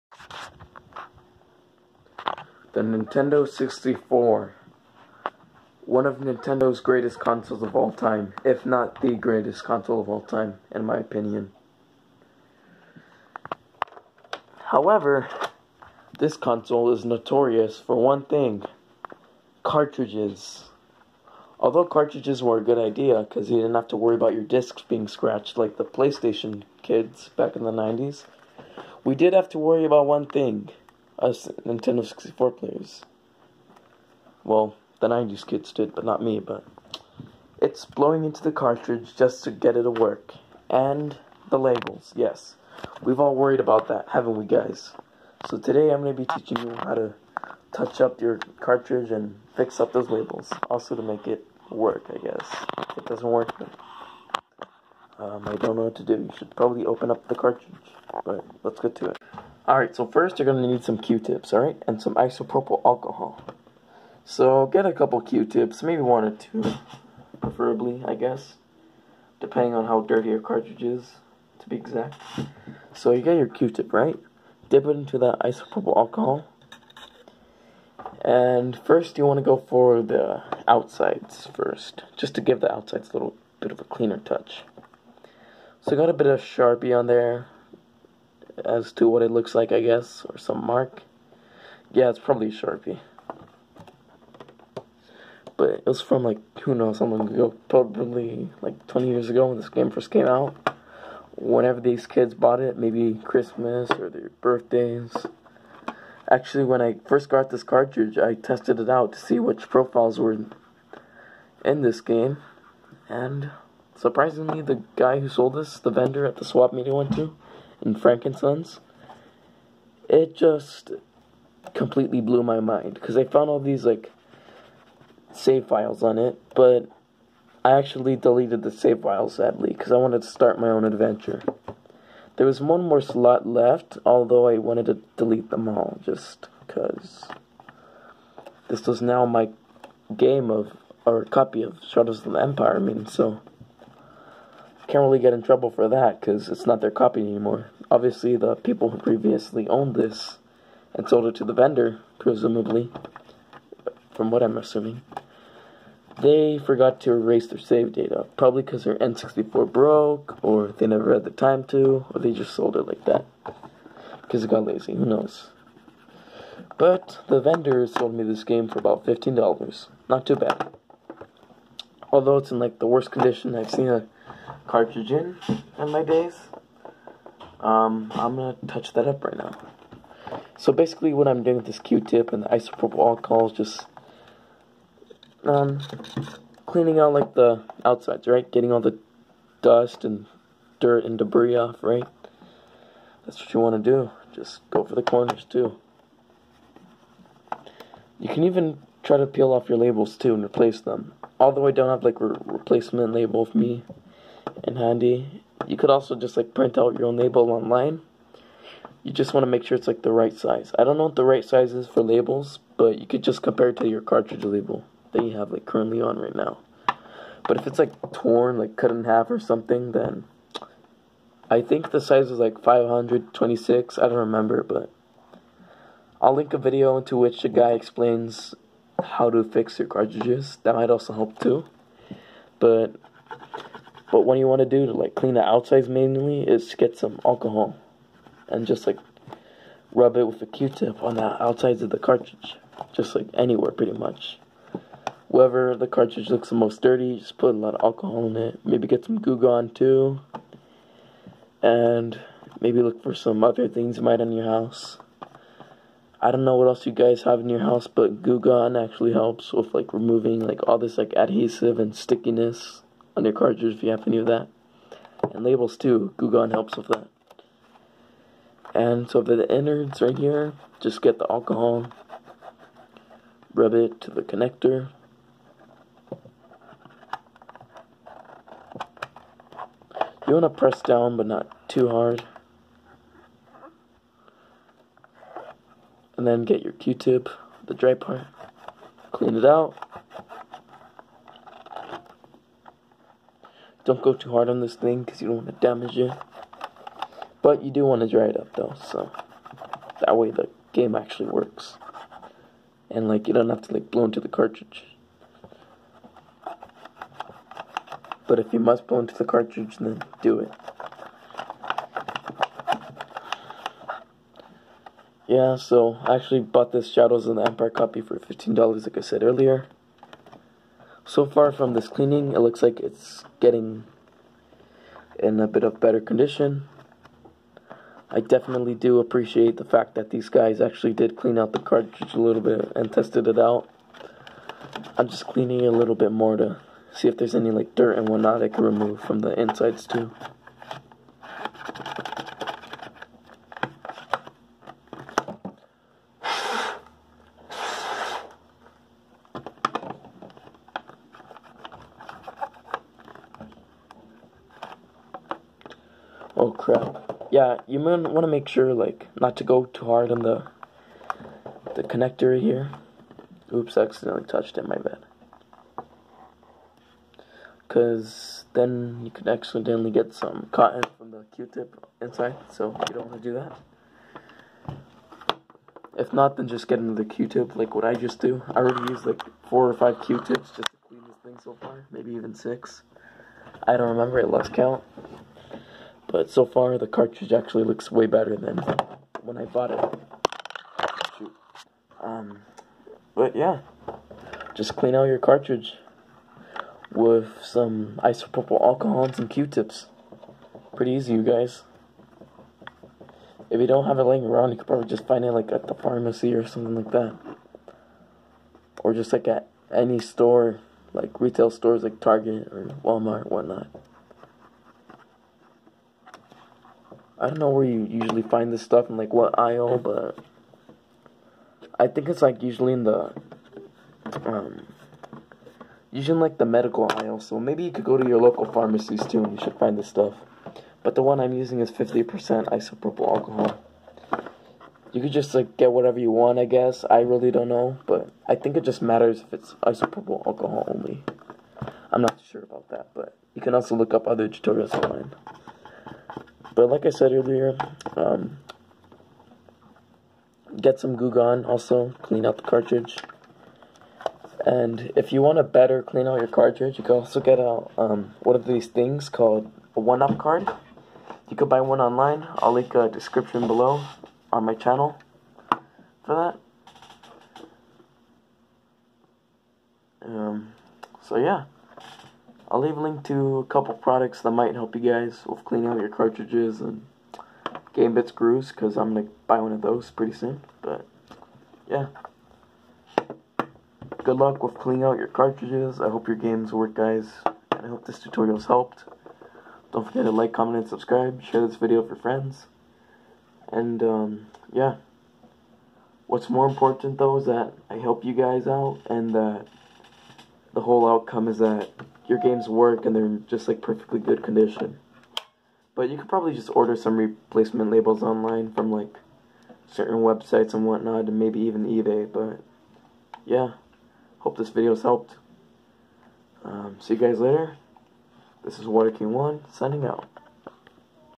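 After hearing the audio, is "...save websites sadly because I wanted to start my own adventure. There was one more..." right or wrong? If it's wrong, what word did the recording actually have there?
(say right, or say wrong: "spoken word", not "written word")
wrong: "files", not "websites".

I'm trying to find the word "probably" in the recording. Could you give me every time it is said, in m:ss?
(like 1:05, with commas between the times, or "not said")
0:56, 1:32, 1:37, 2:38, 6:44, 8:26.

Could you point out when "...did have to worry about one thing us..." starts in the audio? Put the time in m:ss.
0:29.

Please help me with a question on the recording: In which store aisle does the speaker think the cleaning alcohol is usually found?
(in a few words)
medical aisle.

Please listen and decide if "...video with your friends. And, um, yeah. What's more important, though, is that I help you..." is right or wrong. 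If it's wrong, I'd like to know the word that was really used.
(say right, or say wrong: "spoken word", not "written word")
right.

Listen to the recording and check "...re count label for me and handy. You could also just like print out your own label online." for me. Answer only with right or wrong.
wrong.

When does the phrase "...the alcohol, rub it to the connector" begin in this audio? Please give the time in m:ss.
4:31.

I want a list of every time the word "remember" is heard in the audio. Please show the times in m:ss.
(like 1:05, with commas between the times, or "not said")
3:44, 6:23.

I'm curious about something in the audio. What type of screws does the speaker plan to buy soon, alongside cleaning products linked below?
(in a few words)
game bit screws.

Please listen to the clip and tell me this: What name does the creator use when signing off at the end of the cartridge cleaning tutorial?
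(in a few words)
Water King One.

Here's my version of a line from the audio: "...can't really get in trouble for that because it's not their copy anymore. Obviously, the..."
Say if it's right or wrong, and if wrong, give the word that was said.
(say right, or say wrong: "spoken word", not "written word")
right.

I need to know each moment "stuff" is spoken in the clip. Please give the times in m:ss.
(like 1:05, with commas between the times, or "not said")
6:58, 7:09.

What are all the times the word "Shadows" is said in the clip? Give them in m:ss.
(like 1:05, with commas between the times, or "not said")
2:21, 5:16.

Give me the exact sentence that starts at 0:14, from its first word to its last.
However, this console is notorious for one thing cartridges.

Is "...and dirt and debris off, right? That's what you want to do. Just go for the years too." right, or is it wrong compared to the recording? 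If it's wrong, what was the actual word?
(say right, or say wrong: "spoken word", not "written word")
wrong: "corners", not "years".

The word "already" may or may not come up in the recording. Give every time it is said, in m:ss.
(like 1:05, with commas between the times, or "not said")
6:18.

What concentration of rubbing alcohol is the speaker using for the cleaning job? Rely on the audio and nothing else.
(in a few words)
50%.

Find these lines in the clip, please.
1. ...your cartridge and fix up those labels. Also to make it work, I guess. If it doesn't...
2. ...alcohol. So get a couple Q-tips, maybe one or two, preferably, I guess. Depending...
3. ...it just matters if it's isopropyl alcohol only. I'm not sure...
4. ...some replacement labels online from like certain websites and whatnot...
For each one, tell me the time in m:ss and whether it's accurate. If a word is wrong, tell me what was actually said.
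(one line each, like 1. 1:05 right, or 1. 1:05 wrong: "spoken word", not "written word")
1. 0:48 right
2. 1:02 right
3. 7:18 right
4. 8:26 right.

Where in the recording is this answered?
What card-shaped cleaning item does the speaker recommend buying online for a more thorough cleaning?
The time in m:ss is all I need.
7:39.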